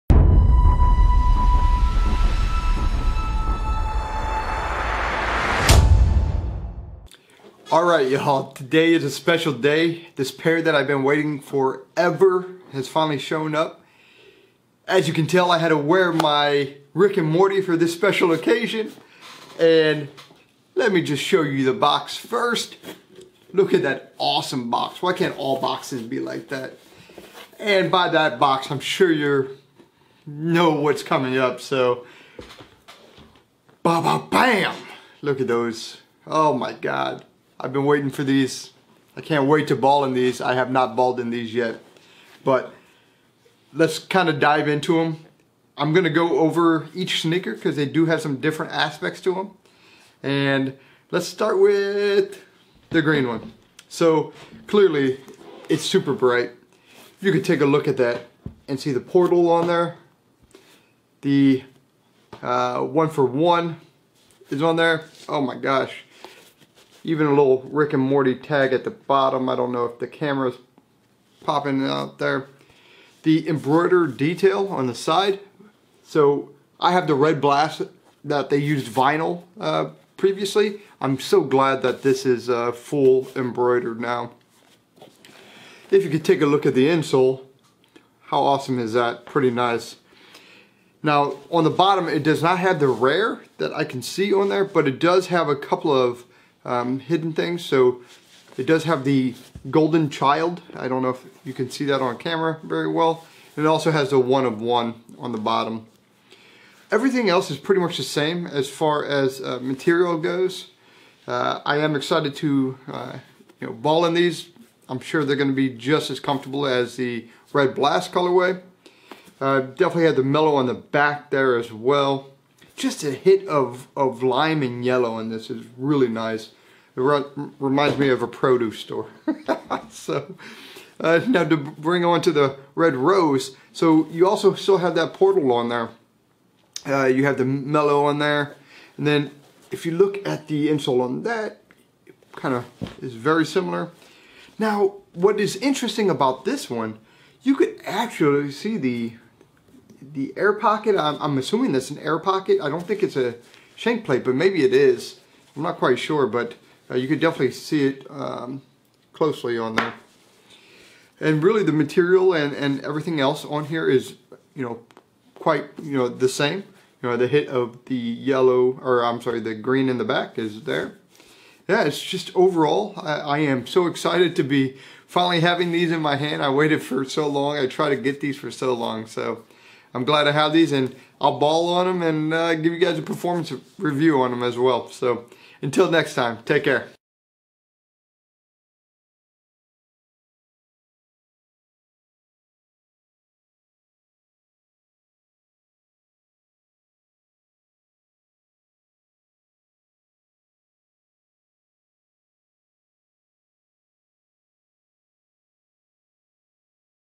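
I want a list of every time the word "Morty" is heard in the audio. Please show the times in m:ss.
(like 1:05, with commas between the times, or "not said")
0:17, 1:08.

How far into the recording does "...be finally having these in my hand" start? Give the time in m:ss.
2:54.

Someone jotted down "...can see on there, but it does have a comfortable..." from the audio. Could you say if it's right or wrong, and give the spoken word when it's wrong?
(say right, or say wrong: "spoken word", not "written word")
wrong: "couple", not "comfortable".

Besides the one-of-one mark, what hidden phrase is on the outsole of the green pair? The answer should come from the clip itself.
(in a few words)
golden child.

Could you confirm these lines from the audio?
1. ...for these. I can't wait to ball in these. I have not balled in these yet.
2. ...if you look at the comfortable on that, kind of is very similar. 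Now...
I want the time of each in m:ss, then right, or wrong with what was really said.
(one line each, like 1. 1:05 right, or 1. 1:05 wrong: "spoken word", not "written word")
1. 0:38 right
2. 2:19 wrong: "insole", not "comfortable".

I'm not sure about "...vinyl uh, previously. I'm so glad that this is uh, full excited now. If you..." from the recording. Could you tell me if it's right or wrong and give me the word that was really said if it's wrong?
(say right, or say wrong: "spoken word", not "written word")
wrong: "embroidered", not "excited".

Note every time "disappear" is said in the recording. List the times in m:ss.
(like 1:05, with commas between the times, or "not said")
not said.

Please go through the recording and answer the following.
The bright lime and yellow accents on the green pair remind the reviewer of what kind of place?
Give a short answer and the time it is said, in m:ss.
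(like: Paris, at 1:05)
a produce store, at 2:08.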